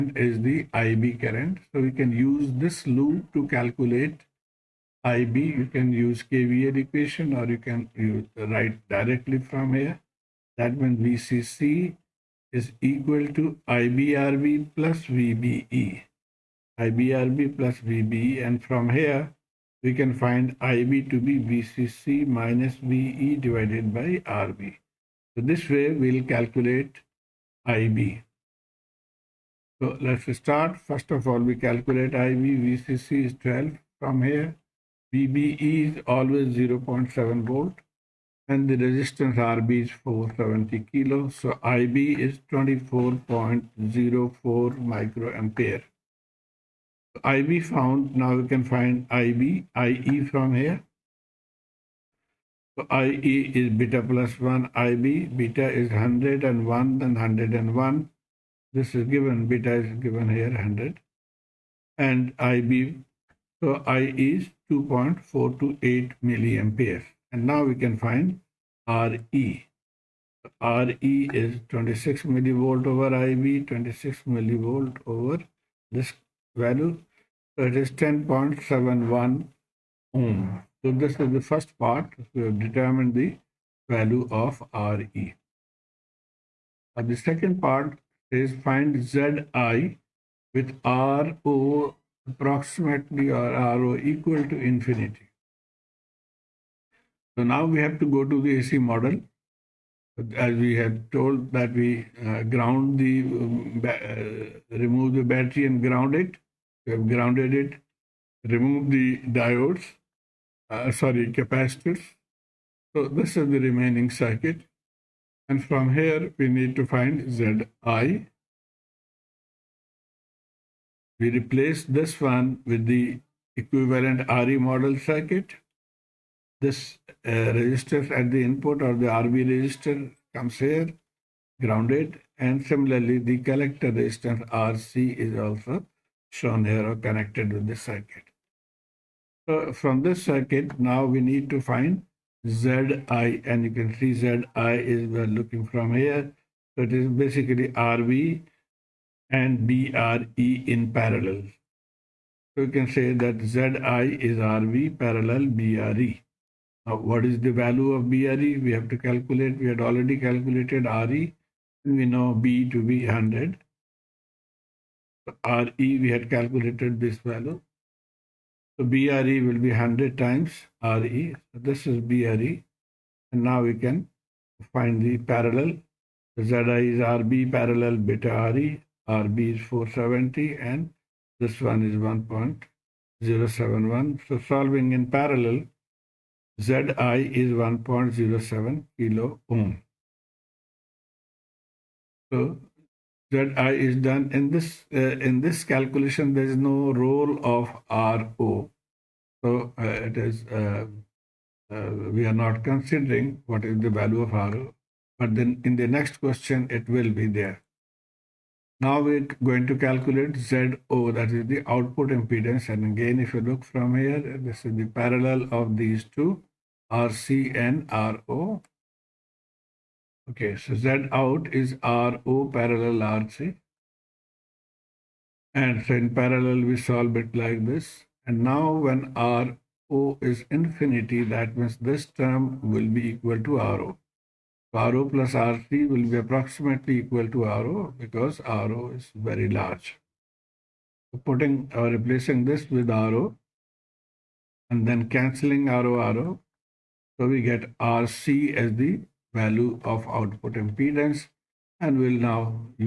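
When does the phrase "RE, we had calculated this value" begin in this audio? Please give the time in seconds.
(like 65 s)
165 s.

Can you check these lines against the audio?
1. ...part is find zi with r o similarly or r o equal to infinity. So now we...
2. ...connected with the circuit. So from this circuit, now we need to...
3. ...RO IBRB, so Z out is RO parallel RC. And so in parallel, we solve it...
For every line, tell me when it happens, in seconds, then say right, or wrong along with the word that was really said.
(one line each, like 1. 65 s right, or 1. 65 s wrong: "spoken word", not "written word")
1. 87 s wrong: "approximately", not "similarly"
2. 136 s right
3. 218 s wrong: "Okay", not "IBRB".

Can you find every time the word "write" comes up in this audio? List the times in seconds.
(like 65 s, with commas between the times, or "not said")
8 s.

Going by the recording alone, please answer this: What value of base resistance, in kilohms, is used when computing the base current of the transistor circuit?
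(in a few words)
470 kilohm.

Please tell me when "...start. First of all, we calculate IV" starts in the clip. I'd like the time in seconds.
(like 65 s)
30 s.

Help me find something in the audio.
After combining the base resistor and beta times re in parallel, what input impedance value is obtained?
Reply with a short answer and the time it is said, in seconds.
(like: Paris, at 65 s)
1.07 kilohm, at 187 s.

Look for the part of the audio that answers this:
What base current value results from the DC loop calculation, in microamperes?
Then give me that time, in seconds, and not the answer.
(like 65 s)
42 s.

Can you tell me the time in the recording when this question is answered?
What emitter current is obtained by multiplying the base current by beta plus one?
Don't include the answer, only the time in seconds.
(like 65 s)
64 s.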